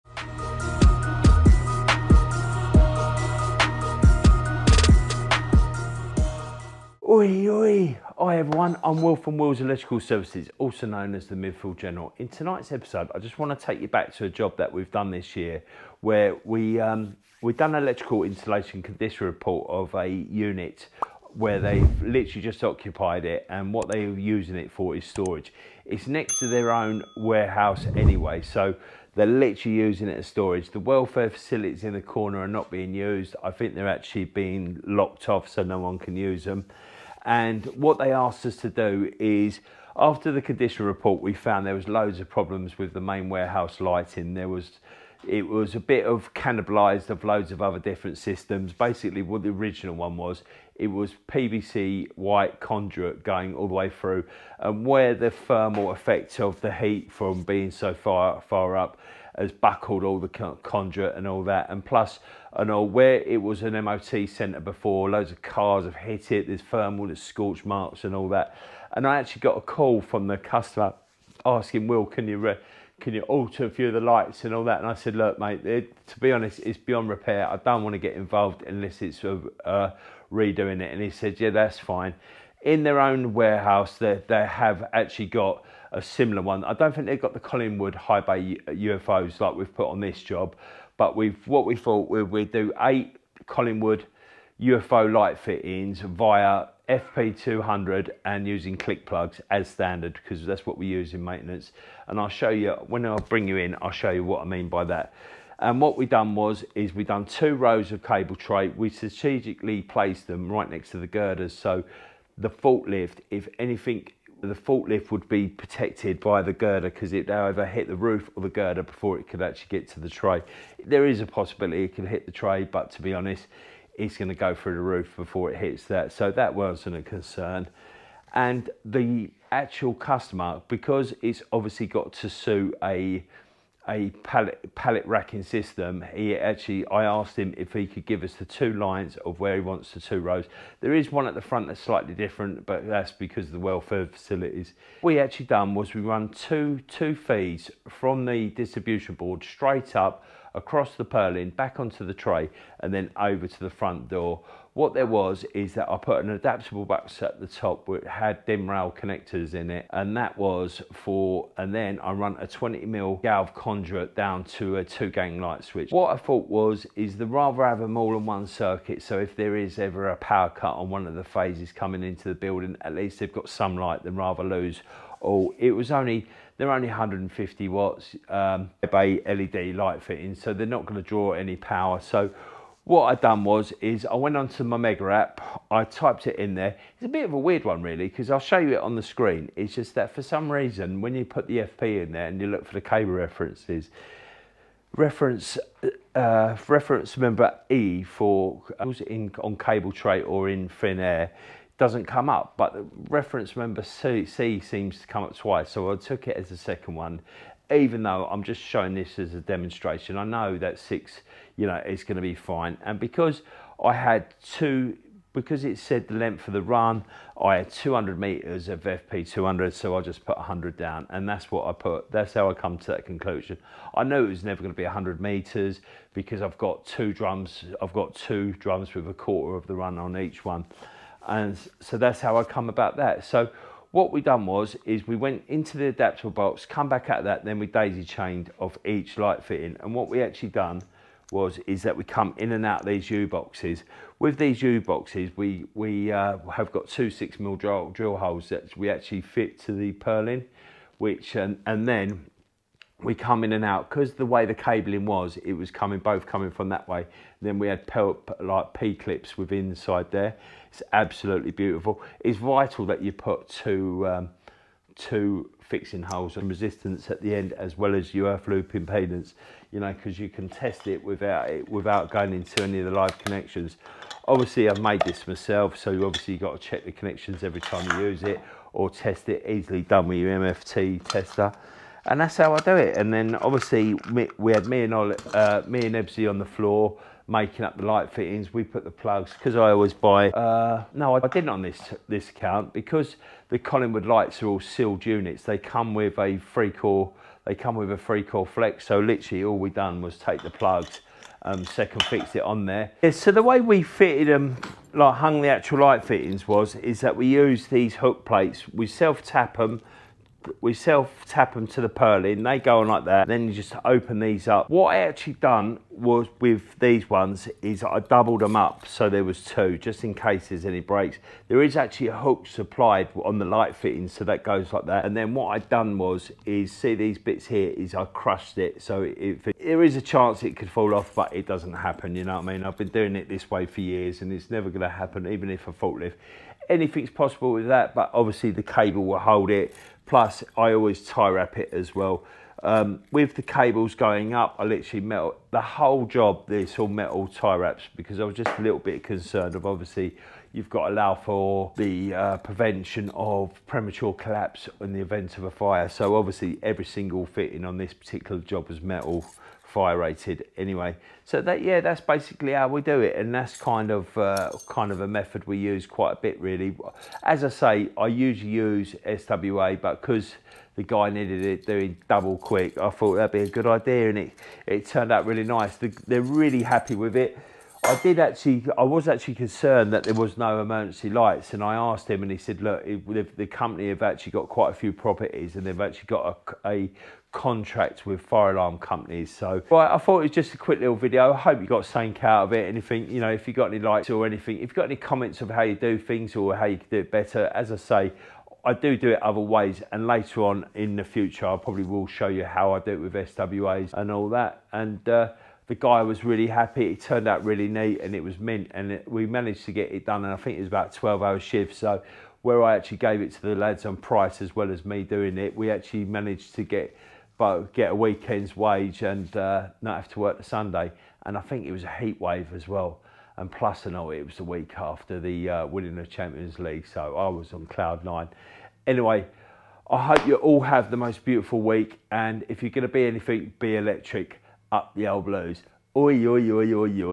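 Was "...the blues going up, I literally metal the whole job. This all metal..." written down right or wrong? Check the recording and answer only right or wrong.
wrong.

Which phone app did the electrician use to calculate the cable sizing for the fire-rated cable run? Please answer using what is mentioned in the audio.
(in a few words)
Mega.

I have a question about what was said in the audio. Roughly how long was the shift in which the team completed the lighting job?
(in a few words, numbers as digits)
12 hours.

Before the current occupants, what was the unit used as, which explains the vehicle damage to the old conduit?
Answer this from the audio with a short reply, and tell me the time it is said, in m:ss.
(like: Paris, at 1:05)
MOT centre, at 1:03.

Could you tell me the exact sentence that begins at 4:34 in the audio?
Obviously, I've made this myself, so you obviously got to check the connections every time you use it or test it.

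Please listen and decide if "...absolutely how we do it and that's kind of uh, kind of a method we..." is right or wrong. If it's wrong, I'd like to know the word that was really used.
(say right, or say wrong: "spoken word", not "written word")
wrong: "basically", not "absolutely".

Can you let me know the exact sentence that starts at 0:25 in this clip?
It's next to their own warehouse anyway, so they're literally using it as storage.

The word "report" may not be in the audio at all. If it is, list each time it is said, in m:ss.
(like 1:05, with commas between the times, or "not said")
0:19, 0:40.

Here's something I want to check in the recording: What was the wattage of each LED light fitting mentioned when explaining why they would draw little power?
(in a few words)
150 watts.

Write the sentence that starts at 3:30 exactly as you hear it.
I know that six, you know, is going to be fine.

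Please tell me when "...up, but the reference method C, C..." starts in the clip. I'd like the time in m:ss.
3:22.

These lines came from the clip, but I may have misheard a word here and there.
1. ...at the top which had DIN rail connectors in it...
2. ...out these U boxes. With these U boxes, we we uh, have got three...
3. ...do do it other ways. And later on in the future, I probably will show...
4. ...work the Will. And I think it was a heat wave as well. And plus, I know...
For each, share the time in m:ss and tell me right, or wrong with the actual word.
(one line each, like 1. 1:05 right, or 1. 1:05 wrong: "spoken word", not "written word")
1. 2:37 right
2. 4:02 wrong: "two", not "three"
3. 6:38 right
4. 7:00 wrong: "Sunday", not "Will".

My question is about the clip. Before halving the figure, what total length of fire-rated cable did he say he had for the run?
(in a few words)
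200 meters.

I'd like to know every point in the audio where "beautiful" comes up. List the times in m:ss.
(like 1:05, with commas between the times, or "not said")
4:21, 7:11.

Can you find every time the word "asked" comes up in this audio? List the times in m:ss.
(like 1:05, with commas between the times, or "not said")
0:38, 2:17, 6:21.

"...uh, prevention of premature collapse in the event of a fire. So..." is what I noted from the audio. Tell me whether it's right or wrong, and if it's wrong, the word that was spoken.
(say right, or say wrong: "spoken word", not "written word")
right.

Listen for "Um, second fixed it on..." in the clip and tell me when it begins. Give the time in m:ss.
5:01.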